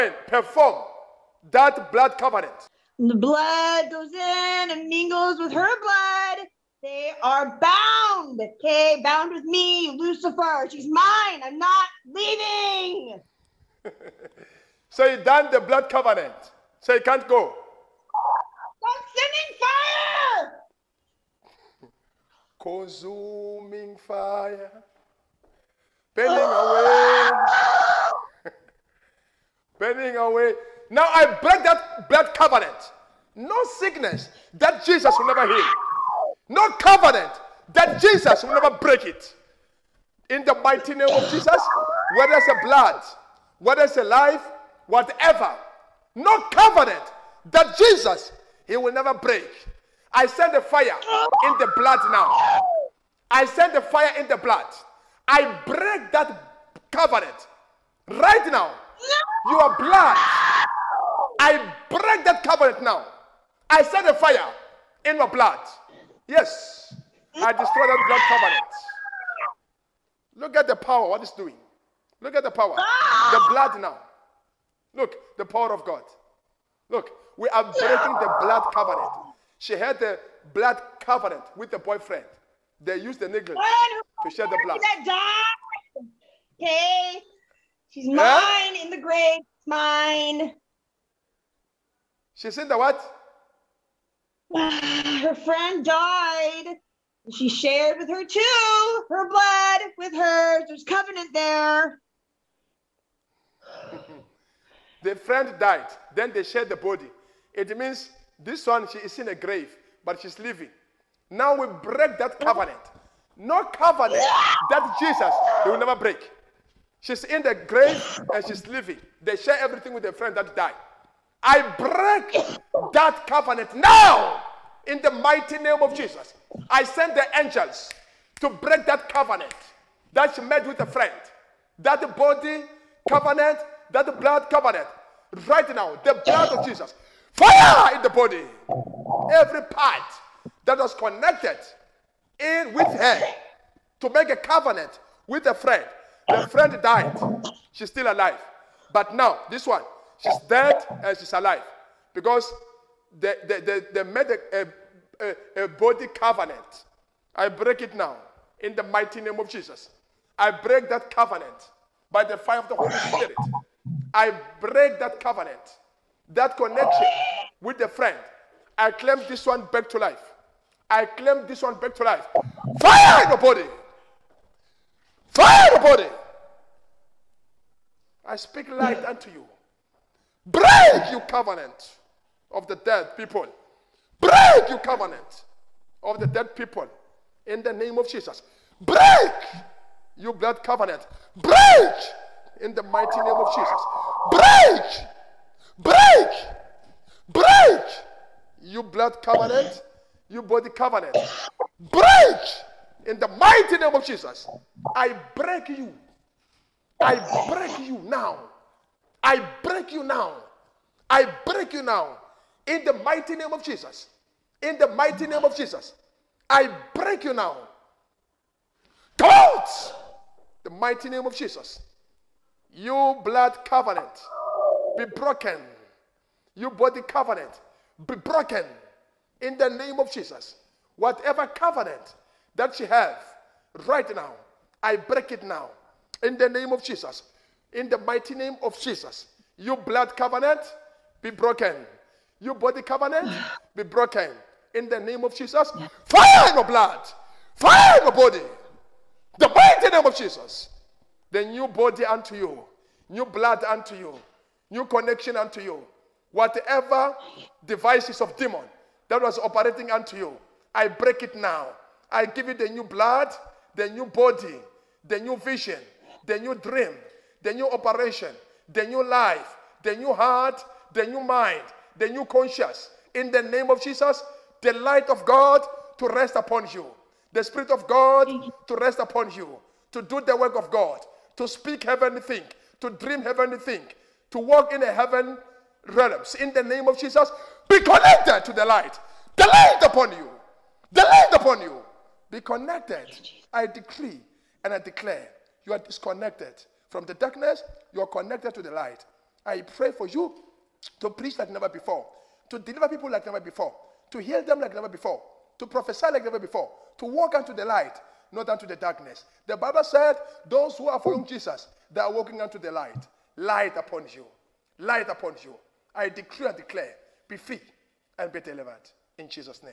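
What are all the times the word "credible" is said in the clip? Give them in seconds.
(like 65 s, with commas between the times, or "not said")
not said.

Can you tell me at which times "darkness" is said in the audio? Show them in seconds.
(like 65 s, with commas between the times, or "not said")
297 s, 308 s.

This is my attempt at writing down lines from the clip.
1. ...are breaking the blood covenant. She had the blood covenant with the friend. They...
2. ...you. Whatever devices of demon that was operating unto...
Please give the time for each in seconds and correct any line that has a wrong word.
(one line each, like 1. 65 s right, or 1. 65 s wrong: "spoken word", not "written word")
1. 77 s wrong: "boyfriend", not "friend"
2. 255 s right.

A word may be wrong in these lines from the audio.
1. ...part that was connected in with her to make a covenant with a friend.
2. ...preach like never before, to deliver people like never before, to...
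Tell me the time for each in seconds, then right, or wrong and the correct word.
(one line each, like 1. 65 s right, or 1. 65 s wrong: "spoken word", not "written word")
1. 139 s right
2. 301 s right.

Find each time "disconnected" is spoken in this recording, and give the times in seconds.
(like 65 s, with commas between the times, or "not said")
295 s.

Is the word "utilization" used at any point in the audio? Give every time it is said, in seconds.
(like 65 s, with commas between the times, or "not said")
not said.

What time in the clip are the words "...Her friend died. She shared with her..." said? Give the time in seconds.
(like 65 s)
95 s.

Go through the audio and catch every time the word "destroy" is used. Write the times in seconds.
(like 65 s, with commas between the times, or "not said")
67 s.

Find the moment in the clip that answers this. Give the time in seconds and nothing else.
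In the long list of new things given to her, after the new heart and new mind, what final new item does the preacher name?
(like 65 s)
271 s.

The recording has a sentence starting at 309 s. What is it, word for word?
The Bible said, Those who are following mm.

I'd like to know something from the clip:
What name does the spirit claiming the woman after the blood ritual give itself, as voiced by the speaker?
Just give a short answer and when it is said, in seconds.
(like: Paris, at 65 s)
Lucifer, at 9 s.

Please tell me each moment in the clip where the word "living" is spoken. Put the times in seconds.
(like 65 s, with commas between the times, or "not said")
110 s, 118 s.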